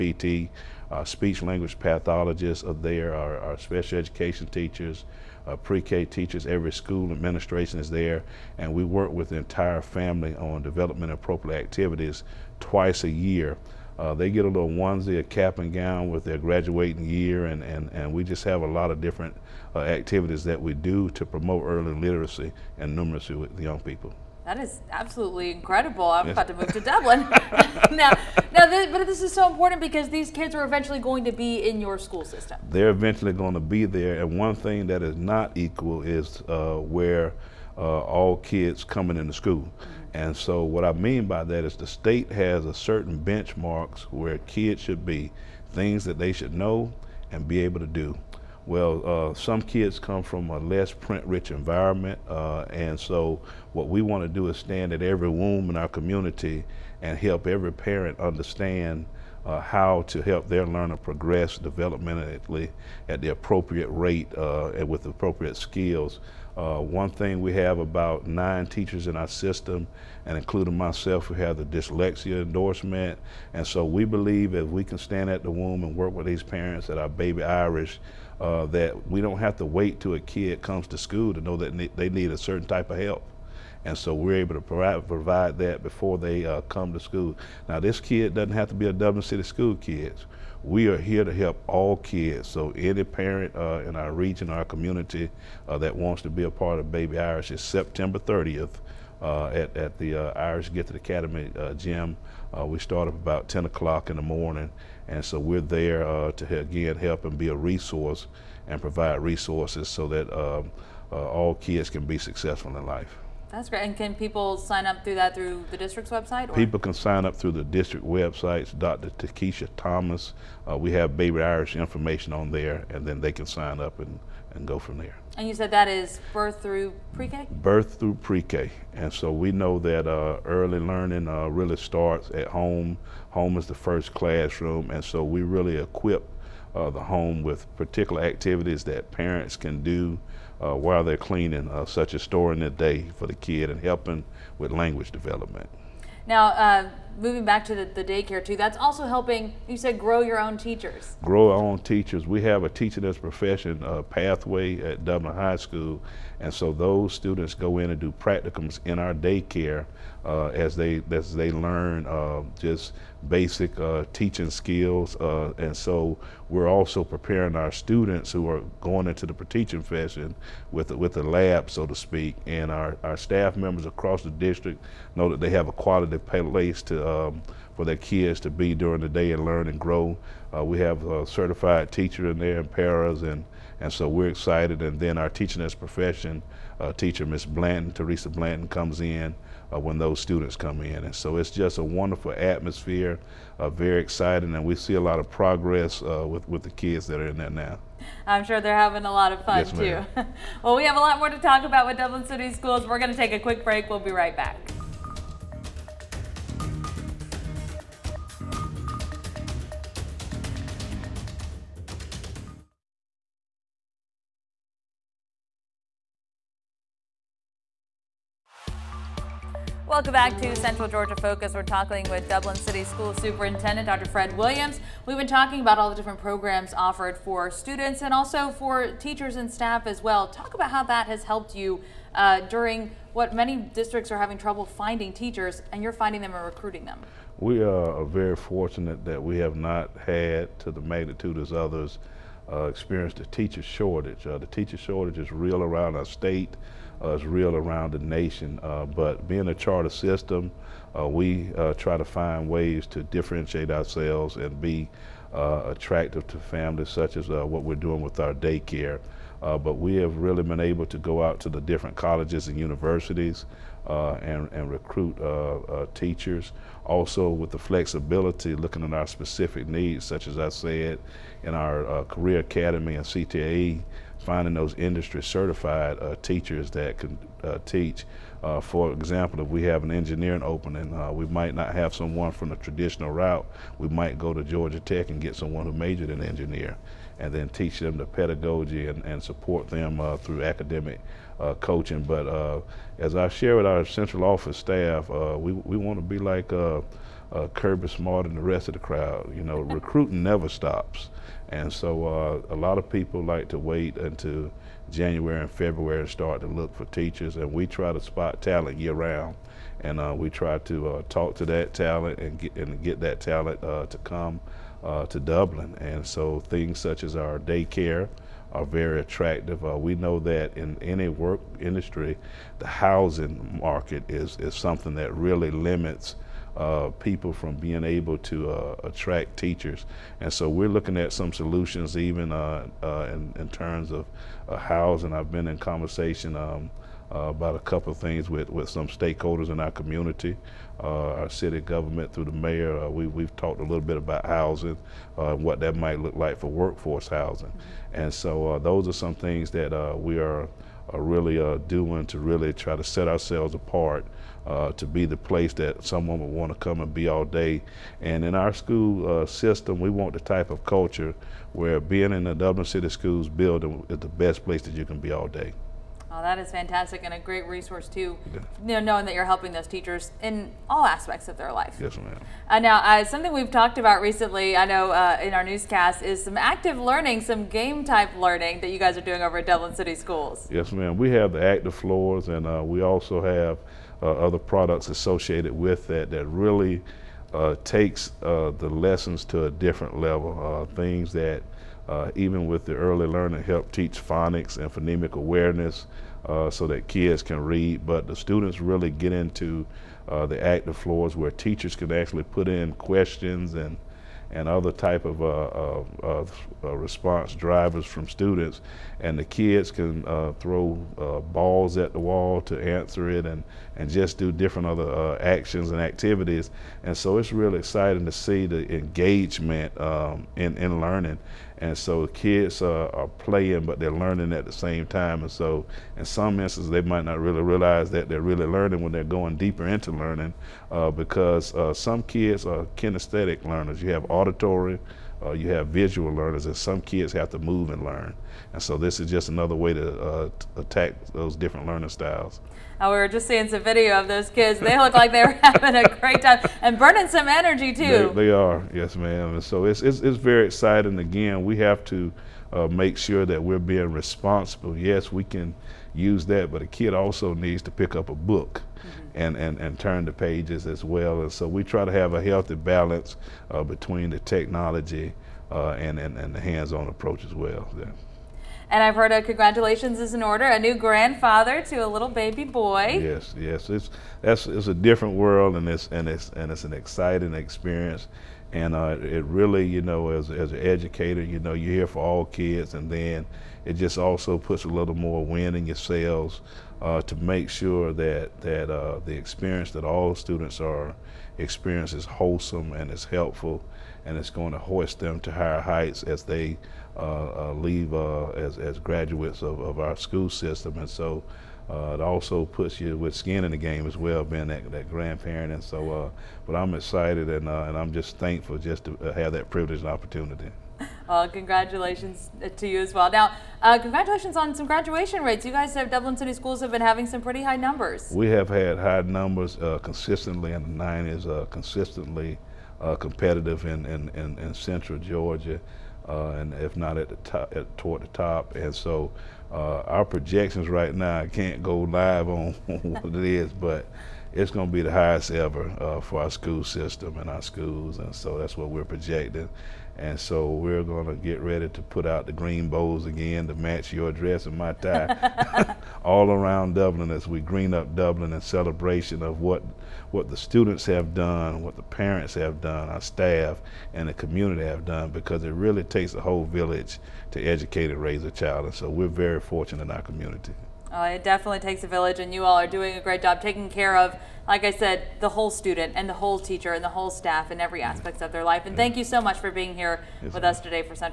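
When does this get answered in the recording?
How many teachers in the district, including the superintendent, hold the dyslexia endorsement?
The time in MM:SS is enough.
01:08.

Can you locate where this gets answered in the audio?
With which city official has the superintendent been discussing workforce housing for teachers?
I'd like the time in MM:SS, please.
05:42.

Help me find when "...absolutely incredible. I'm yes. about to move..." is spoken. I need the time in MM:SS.
00:24.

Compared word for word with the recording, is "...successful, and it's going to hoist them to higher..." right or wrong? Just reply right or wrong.
wrong.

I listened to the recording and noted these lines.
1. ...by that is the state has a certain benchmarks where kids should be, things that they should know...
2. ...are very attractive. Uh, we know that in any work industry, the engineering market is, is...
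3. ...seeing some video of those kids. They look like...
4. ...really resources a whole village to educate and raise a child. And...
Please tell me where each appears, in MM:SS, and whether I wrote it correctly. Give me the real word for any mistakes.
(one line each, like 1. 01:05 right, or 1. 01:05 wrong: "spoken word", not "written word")
1. 00:41 right
2. 05:18 wrong: "housing", not "engineering"
3. 07:23 right
4. 09:15 wrong: "takes", not "resources".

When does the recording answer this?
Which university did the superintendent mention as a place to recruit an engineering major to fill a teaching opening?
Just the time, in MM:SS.
04:44.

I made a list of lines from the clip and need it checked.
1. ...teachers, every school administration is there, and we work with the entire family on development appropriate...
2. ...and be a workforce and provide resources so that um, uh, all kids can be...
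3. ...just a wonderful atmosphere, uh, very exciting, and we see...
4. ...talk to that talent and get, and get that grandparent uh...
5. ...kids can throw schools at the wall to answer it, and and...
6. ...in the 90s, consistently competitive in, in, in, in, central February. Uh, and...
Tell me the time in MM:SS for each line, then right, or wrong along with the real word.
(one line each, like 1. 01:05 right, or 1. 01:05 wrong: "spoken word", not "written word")
1. 00:06 right
2. 01:47 wrong: "resource", not "workforce"
3. 03:11 right
4. 05:11 wrong: "talent", not "grandparent"
5. 06:49 wrong: "balls", not "schools"
6. 08:40 wrong: "Georgia", not "February".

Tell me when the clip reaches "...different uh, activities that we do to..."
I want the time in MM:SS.
00:18.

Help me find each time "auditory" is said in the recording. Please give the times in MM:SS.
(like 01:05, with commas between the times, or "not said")
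07:14.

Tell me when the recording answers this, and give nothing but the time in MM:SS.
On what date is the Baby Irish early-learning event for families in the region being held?
01:37.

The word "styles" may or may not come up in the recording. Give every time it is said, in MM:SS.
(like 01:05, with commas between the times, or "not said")
07:21.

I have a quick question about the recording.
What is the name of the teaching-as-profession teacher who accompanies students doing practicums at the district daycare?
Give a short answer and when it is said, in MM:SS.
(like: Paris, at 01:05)
Teresa Blanton, at 03:07.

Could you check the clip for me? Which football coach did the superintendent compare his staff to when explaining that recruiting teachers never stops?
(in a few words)
Kirby Smart.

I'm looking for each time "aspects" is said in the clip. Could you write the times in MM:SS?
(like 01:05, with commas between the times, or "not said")
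06:10, 09:27.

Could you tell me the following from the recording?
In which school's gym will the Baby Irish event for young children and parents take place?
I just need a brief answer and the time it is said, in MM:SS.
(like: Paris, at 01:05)
Irish Gifted Academy, at 01:40.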